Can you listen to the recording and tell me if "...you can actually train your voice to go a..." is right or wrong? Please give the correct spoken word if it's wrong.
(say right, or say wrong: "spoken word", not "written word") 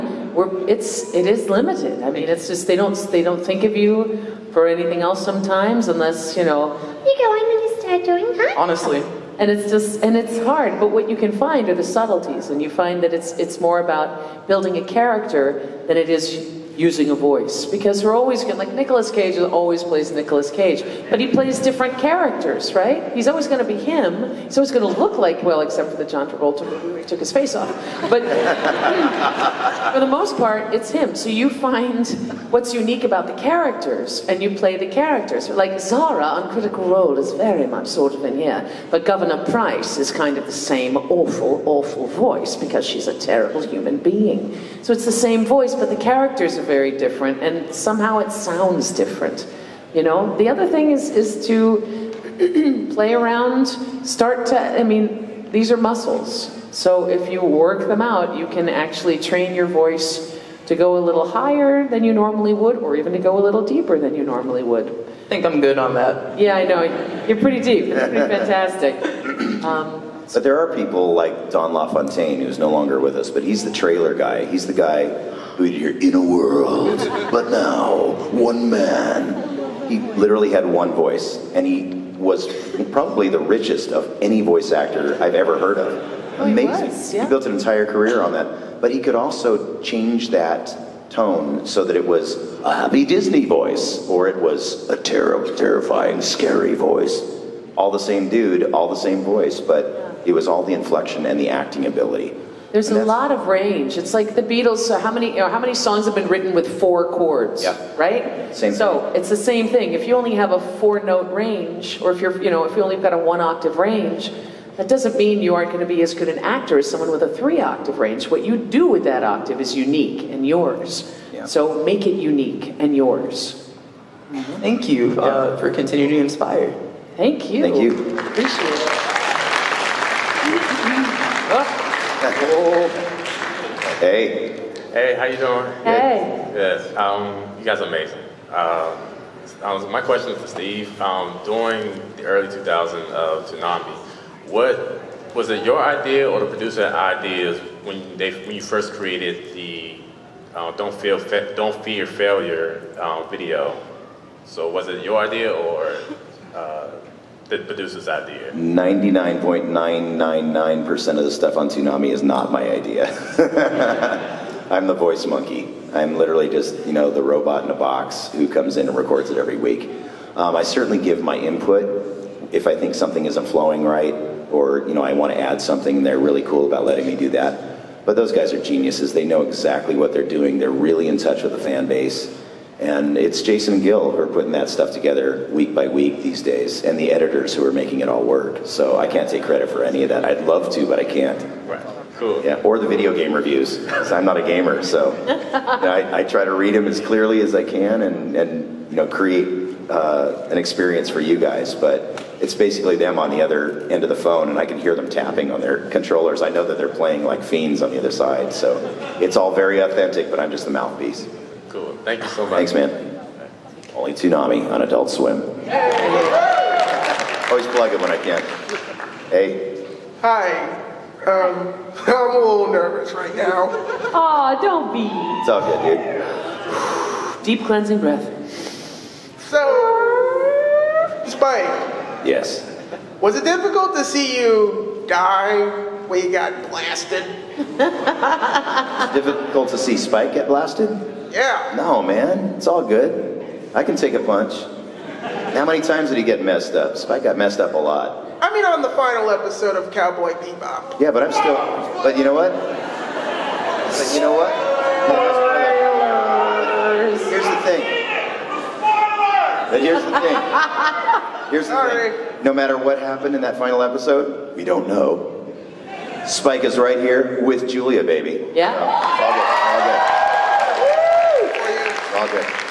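right.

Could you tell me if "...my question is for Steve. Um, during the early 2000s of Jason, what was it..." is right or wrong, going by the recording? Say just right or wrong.
wrong.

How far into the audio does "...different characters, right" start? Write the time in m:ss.
0:21.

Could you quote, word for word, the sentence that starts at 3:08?
So I can't take credit for any of that.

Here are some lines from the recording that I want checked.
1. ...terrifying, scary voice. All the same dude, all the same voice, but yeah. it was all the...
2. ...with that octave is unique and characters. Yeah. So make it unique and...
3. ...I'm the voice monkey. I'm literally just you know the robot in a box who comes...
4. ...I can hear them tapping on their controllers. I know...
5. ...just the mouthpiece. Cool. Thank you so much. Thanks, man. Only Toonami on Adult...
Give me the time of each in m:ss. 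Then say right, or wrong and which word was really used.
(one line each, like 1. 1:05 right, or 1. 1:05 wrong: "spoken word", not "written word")
1. 1:35 right
2. 1:58 wrong: "yours", not "characters"
3. 2:44 right
4. 3:24 right
5. 3:30 right.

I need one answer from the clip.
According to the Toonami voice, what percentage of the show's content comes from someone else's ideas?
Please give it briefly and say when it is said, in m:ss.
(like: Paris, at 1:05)
99.999%, at 2:38.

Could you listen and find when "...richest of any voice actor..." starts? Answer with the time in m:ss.
1:23.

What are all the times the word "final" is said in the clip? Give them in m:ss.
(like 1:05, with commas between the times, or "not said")
4:08, 4:23.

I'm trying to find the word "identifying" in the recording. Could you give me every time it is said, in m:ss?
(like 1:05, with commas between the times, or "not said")
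not said.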